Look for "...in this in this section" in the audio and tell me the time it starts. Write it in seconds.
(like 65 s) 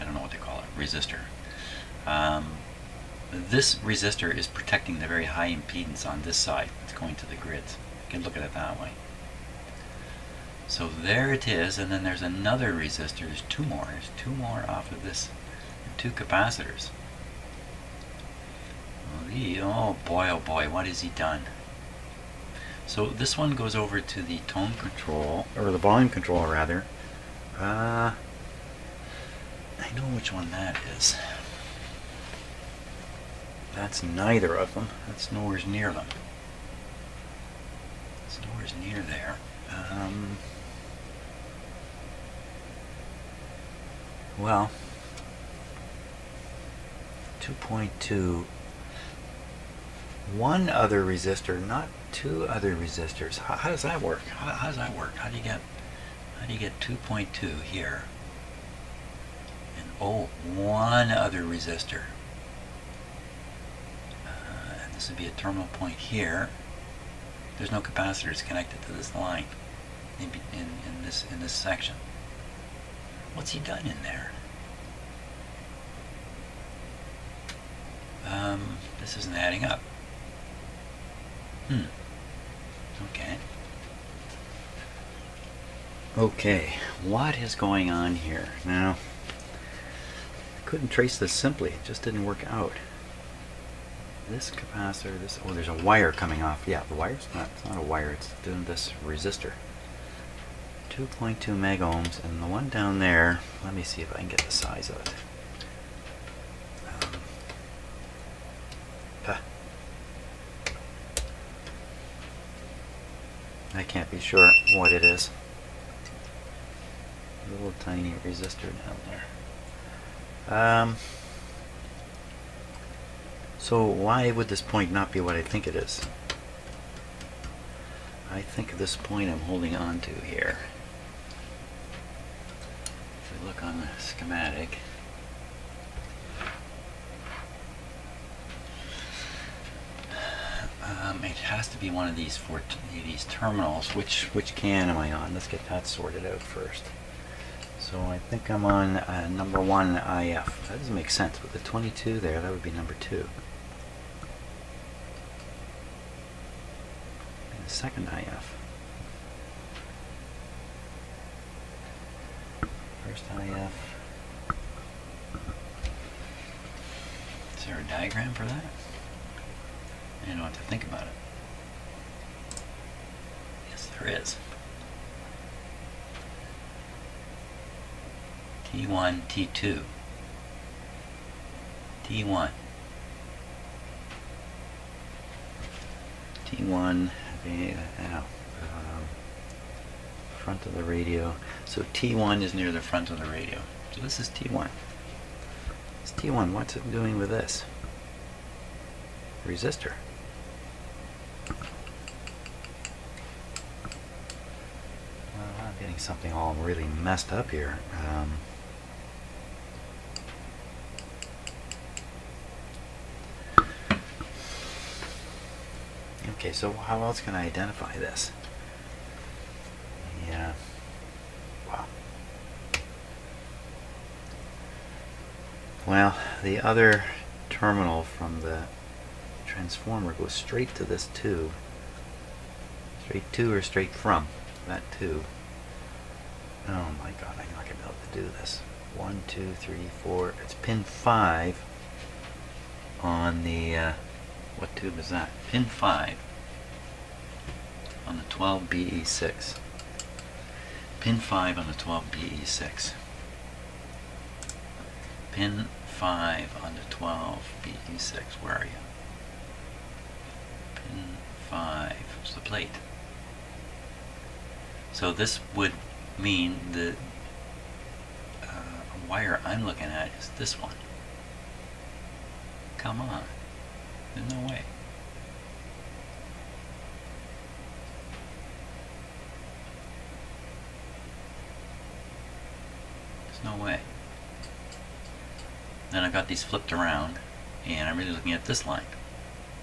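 70 s.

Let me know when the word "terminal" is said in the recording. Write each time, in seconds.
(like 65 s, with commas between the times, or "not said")
65 s, 143 s, 227 s.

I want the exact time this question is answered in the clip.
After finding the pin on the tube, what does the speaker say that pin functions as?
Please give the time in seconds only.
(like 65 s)
262 s.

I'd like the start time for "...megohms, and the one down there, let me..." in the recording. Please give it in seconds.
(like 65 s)
101 s.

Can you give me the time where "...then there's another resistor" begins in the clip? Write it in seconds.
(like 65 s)
11 s.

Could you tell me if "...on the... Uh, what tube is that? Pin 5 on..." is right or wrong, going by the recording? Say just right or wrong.
right.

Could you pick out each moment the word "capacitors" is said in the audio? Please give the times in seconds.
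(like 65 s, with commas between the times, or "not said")
16 s, 67 s, 94 s.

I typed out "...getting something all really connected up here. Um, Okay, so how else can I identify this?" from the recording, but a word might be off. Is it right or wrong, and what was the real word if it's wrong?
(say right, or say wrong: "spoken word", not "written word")
wrong: "messed", not "connected".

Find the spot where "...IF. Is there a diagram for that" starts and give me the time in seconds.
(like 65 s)
163 s.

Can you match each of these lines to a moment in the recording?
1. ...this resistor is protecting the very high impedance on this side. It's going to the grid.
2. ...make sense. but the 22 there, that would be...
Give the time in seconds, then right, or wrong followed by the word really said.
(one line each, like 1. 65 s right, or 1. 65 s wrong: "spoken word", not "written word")
1. 3 s right
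2. 150 s right.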